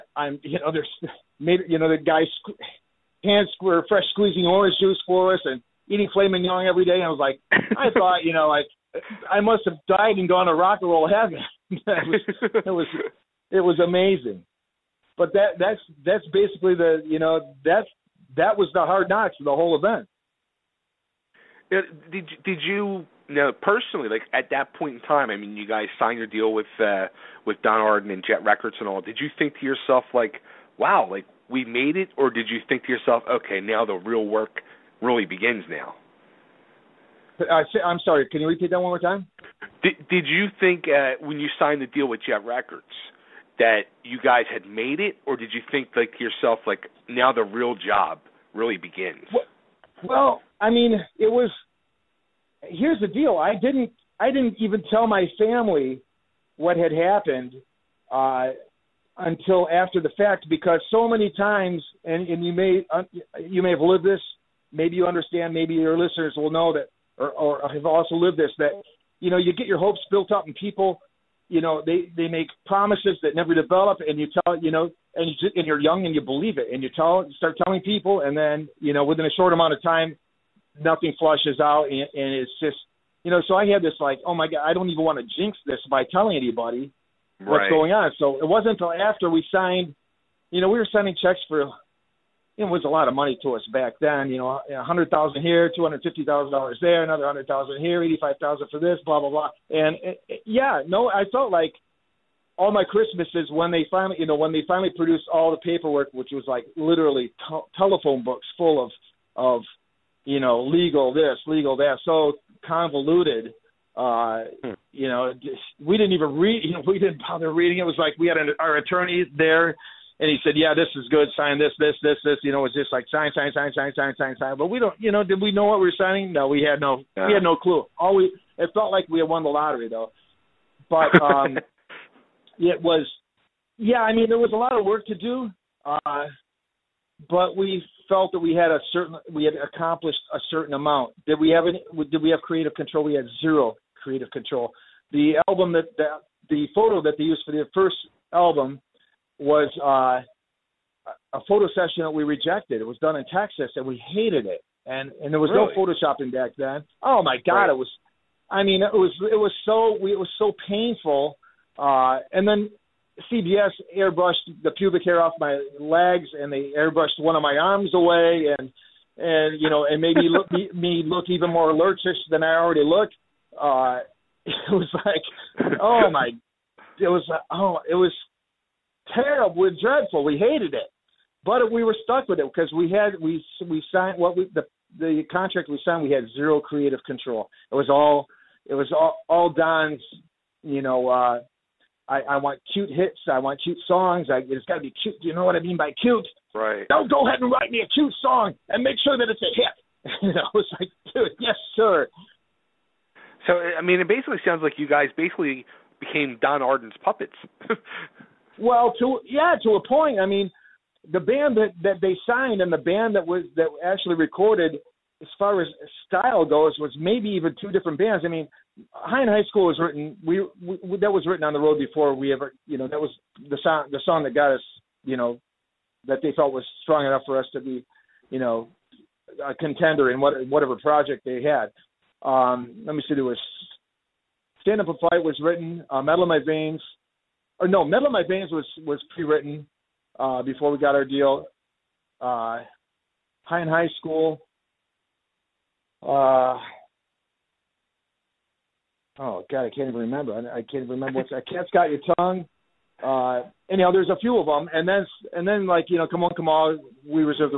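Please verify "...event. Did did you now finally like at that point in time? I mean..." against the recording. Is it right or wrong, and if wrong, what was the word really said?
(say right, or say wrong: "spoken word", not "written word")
wrong: "personally", not "finally".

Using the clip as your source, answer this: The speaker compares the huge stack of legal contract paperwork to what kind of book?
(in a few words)
telephone books.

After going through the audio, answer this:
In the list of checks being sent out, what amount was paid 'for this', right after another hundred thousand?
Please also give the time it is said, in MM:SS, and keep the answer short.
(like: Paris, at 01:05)
$85,000, at 01:38.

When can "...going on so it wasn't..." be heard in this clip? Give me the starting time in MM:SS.
01:27.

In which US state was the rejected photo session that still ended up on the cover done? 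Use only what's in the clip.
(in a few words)
Texas.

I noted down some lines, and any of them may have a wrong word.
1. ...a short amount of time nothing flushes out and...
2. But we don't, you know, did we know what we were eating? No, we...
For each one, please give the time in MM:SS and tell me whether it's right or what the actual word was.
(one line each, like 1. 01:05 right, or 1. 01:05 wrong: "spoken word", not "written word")
1. 01:19 right
2. 02:04 wrong: "signing", not "eating".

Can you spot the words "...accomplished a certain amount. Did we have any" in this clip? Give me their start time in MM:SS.
02:19.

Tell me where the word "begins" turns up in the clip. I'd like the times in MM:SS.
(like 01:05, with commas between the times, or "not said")
00:35, 00:48.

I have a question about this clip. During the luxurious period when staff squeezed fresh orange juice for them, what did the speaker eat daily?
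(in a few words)
filet mignon.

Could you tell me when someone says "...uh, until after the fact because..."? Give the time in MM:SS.
00:58.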